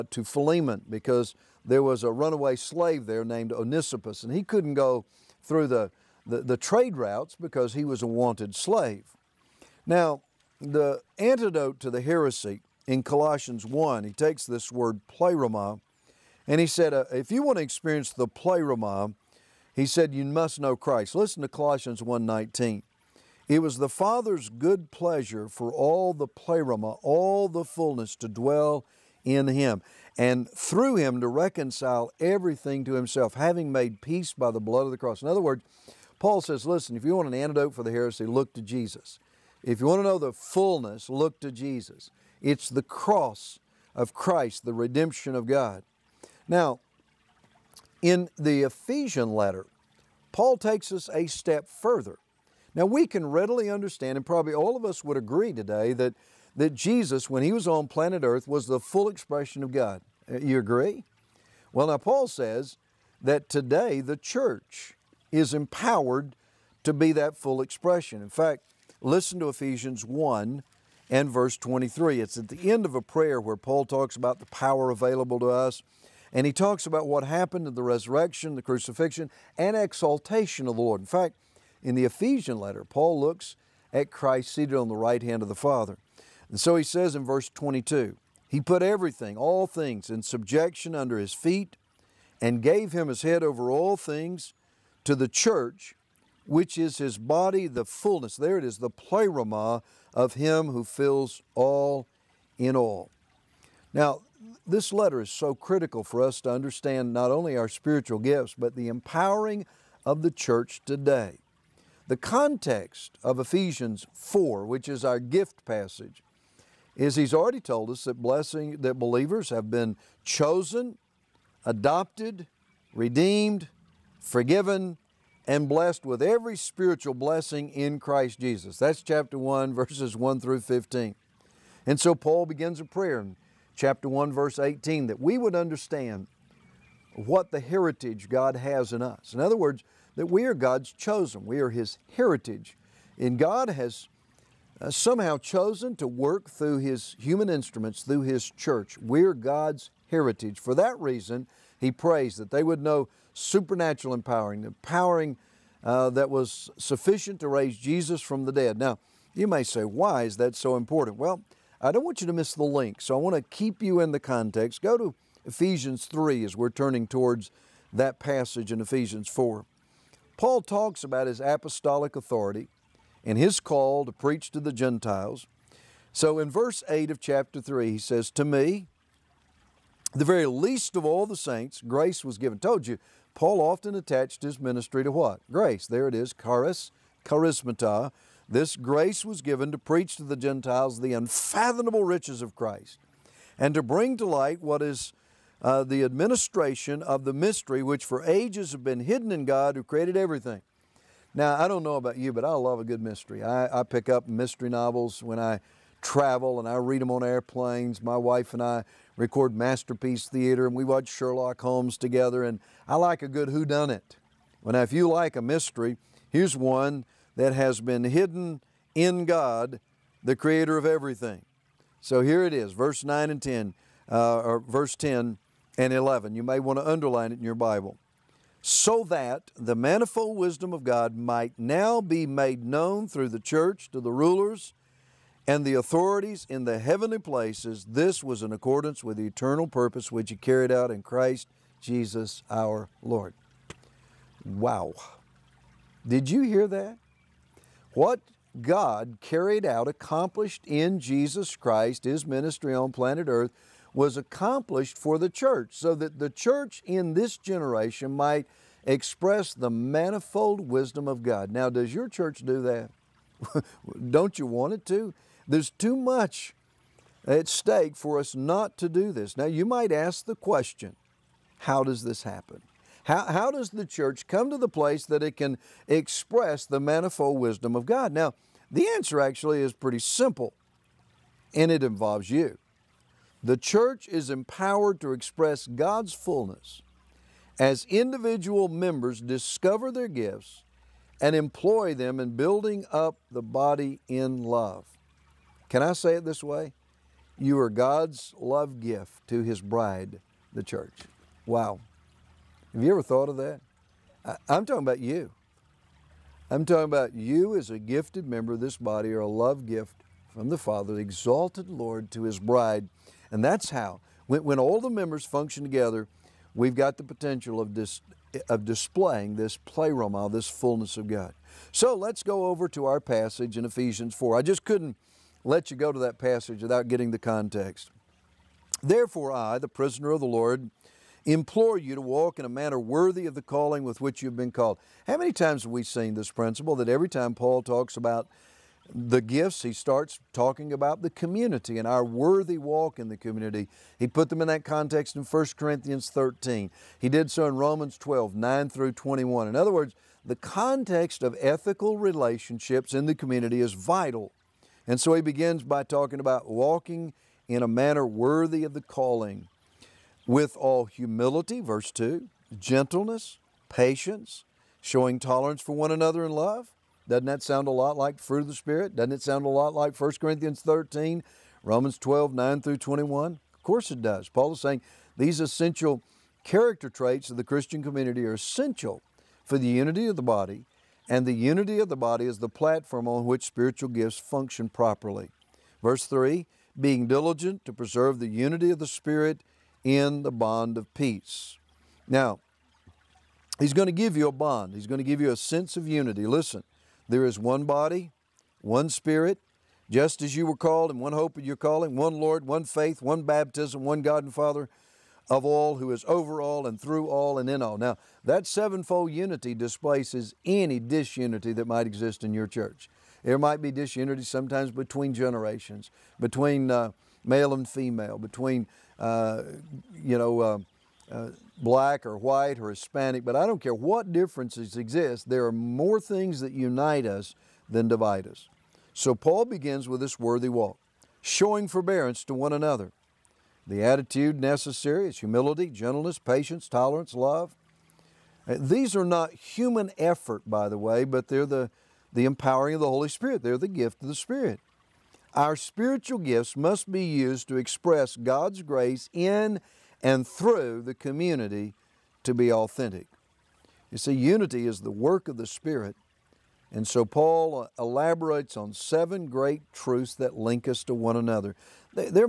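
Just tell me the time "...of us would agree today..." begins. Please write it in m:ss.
0:54.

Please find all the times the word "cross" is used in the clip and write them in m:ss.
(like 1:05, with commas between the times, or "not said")
0:34, 0:42.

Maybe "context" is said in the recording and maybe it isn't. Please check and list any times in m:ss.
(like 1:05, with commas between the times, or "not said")
1:52, 2:44, 5:27, 5:44, 5:50.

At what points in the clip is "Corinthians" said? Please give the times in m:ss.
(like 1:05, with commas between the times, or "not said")
5:45, 6:10.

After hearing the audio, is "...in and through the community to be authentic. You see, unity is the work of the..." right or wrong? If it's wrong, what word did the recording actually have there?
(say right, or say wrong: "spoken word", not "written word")
right.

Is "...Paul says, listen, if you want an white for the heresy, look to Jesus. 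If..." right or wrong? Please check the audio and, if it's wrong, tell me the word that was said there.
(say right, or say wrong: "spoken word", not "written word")
wrong: "antidote", not "white".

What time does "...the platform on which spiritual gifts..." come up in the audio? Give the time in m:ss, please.
6:22.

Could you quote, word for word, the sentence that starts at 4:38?
Now, the answer actually is pretty simple, and it involves you.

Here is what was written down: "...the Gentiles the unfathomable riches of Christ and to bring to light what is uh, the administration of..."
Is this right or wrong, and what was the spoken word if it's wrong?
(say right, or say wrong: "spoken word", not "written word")
right.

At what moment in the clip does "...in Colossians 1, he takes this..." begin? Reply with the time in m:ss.
0:12.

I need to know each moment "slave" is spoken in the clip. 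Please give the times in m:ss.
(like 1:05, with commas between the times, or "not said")
0:02, 0:08.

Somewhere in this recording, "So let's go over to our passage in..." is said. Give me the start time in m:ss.
5:21.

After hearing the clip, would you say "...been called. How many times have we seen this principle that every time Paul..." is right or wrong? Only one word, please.
right.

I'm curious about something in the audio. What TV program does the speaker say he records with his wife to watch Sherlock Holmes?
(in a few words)
Masterpiece Theater.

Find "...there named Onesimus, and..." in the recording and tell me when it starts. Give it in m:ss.
0:03.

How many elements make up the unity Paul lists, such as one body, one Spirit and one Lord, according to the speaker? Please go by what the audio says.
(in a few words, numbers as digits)
7.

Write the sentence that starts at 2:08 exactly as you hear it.
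That's chapter 1, verses 1 through 15.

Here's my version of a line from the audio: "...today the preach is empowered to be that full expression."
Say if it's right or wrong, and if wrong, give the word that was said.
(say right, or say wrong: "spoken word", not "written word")
wrong: "church", not "preach".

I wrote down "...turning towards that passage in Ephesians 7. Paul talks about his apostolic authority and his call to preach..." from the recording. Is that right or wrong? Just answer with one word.
wrong.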